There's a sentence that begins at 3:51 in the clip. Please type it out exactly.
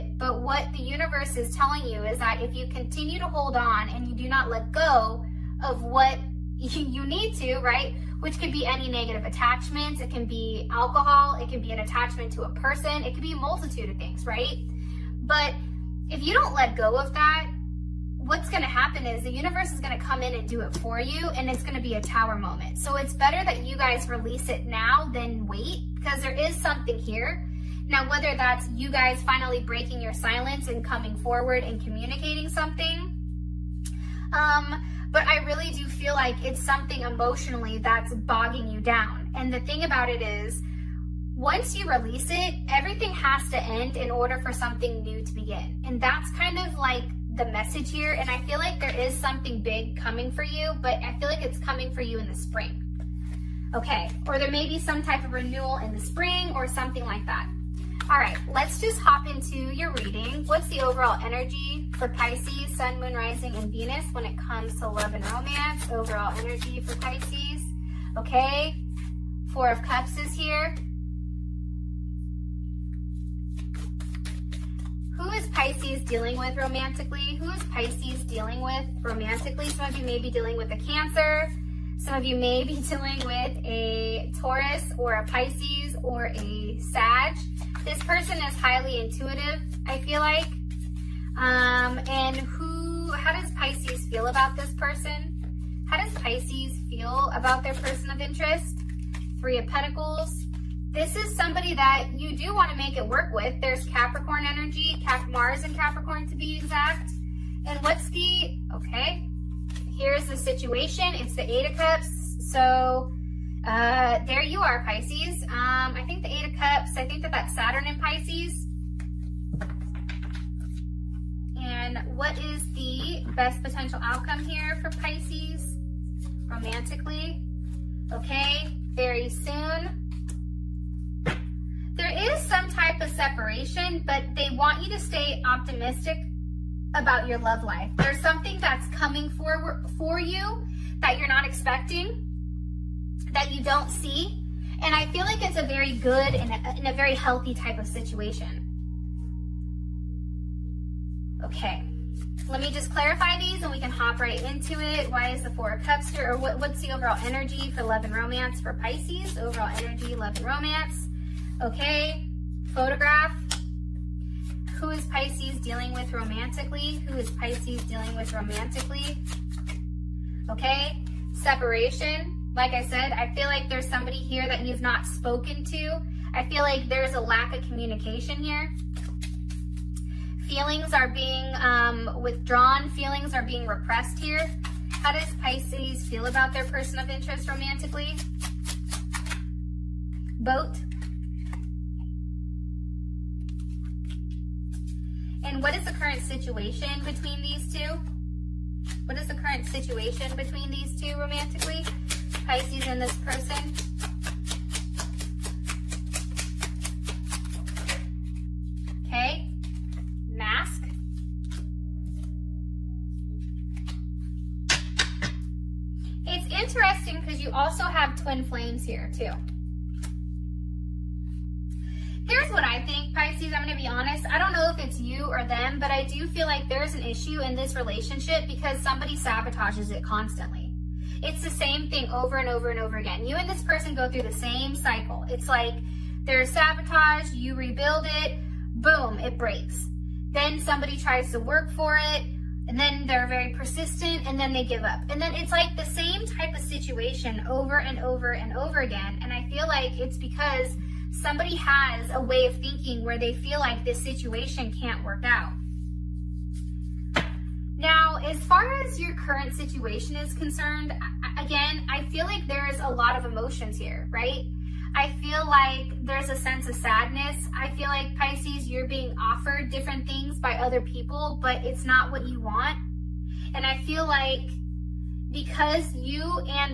It's the same thing over and over and over again.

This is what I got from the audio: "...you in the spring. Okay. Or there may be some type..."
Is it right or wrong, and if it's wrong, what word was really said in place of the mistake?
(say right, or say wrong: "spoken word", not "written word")
right.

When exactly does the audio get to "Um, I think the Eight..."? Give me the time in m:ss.
1:55.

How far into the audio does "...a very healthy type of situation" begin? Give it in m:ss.
2:26.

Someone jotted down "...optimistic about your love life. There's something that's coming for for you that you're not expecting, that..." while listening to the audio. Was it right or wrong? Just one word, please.
right.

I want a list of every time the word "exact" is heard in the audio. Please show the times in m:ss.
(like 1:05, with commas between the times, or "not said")
1:46.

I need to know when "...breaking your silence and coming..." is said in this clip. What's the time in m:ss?
0:29.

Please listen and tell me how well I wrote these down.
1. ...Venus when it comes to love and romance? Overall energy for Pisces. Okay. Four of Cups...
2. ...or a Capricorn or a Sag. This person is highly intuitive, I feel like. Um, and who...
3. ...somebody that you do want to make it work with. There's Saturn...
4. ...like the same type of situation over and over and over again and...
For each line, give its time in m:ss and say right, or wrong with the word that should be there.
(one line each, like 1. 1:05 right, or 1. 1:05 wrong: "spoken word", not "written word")
1. 1:03 right
2. 1:24 wrong: "Pisces", not "Capricorn"
3. 1:41 wrong: "Capricorn", not "Saturn"
4. 4:05 right.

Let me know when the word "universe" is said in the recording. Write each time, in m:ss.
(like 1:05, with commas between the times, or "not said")
0:00, 0:19.